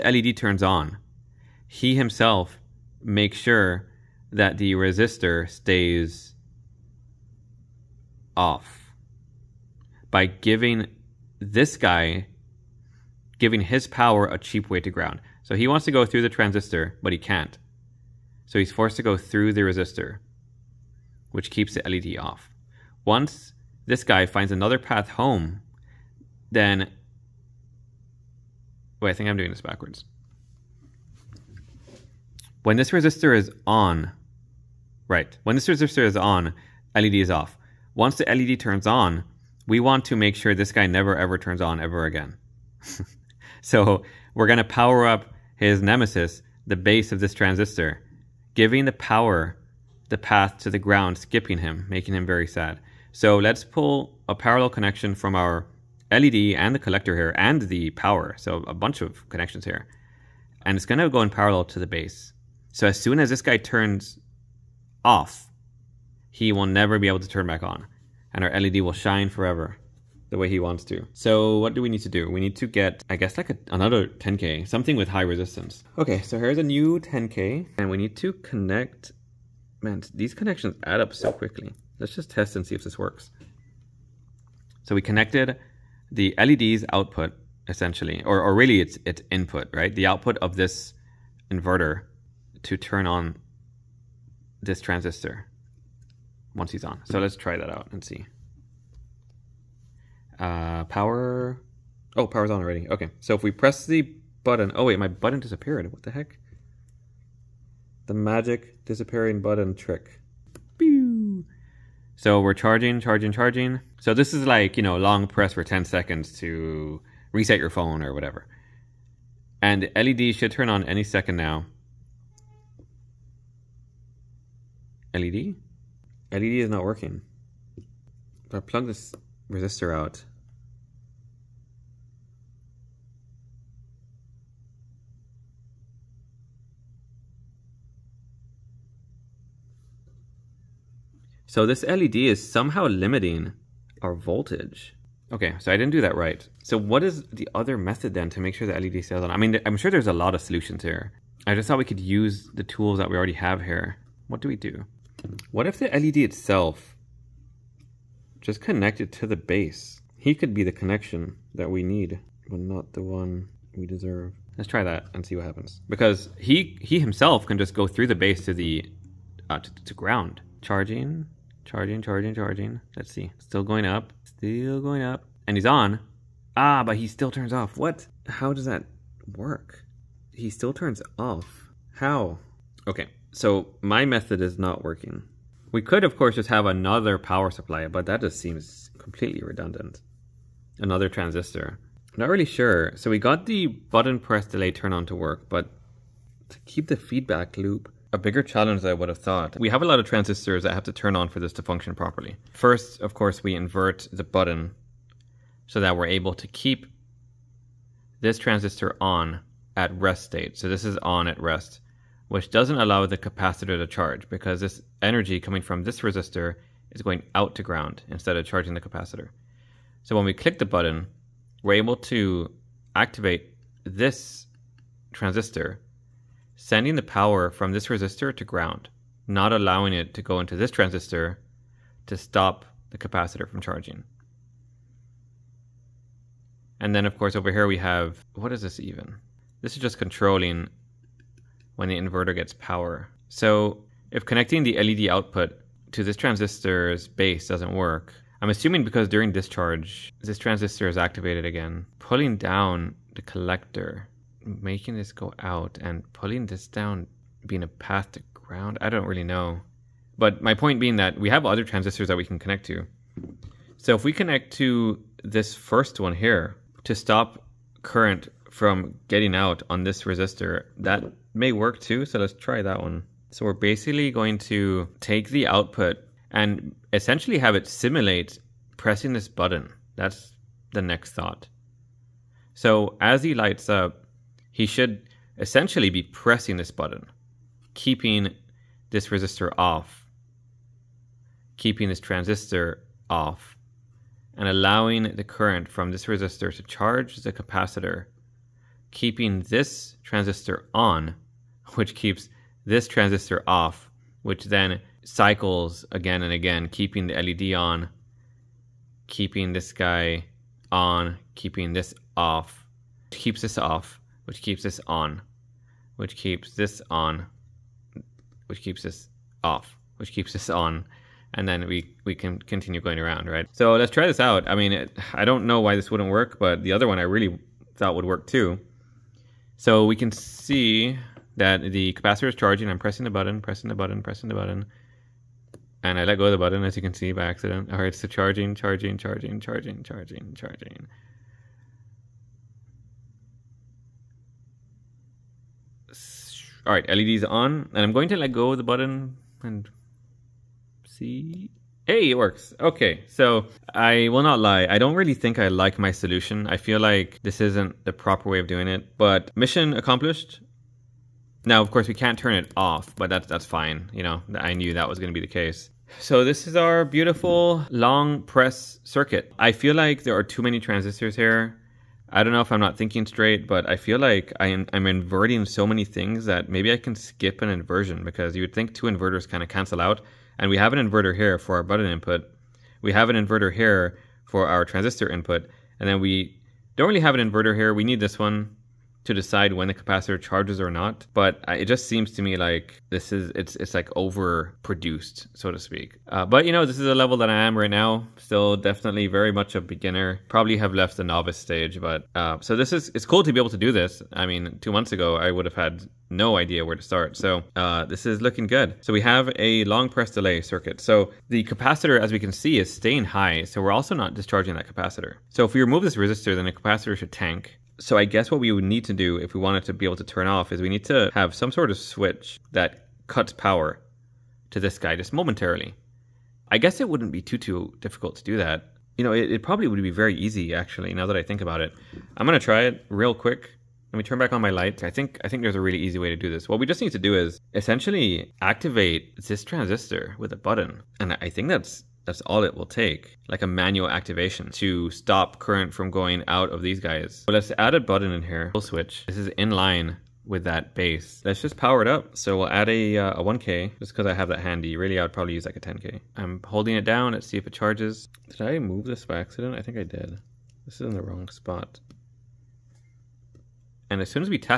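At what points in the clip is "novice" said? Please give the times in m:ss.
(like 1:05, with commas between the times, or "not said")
6:41.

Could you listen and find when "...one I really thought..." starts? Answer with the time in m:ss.
5:26.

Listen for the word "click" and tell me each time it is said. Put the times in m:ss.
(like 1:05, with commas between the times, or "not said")
3:40.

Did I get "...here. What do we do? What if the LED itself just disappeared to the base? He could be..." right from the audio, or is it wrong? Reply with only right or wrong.
wrong.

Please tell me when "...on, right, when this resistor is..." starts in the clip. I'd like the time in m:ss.
0:33.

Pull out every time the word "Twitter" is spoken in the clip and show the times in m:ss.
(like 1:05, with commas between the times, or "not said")
not said.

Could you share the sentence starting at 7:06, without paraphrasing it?
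I guess it wouldn't be too, too difficult to do that.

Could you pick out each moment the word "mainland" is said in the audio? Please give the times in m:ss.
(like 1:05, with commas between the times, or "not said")
not said.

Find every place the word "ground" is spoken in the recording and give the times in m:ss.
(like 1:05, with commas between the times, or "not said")
0:14, 0:50, 2:49, 3:37, 3:48, 4:18.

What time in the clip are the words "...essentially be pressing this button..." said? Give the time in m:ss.
4:45.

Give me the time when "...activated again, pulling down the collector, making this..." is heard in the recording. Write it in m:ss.
4:10.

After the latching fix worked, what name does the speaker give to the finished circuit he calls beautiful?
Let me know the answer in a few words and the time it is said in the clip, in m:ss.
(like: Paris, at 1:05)
long press circuit, at 6:07.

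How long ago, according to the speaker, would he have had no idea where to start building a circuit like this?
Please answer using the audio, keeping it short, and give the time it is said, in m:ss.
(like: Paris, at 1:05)
two months, at 6:44.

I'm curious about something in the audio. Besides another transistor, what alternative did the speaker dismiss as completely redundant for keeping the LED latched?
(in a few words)
another power supply.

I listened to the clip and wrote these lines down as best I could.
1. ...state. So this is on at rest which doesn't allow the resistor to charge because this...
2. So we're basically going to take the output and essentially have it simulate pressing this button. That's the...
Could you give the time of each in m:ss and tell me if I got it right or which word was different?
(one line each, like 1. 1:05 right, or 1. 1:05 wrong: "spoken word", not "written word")
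1. 3:30 wrong: "capacitor", not "resistor"
2. 4:33 right.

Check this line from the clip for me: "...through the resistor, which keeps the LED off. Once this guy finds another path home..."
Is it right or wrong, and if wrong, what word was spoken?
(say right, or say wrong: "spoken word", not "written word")
right.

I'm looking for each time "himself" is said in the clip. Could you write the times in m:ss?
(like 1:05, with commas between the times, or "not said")
0:01, 2:46.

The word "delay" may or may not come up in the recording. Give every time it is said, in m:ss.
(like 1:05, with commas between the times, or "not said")
3:14, 6:50.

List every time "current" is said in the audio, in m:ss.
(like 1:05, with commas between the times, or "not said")
4:27, 4:55, 7:25.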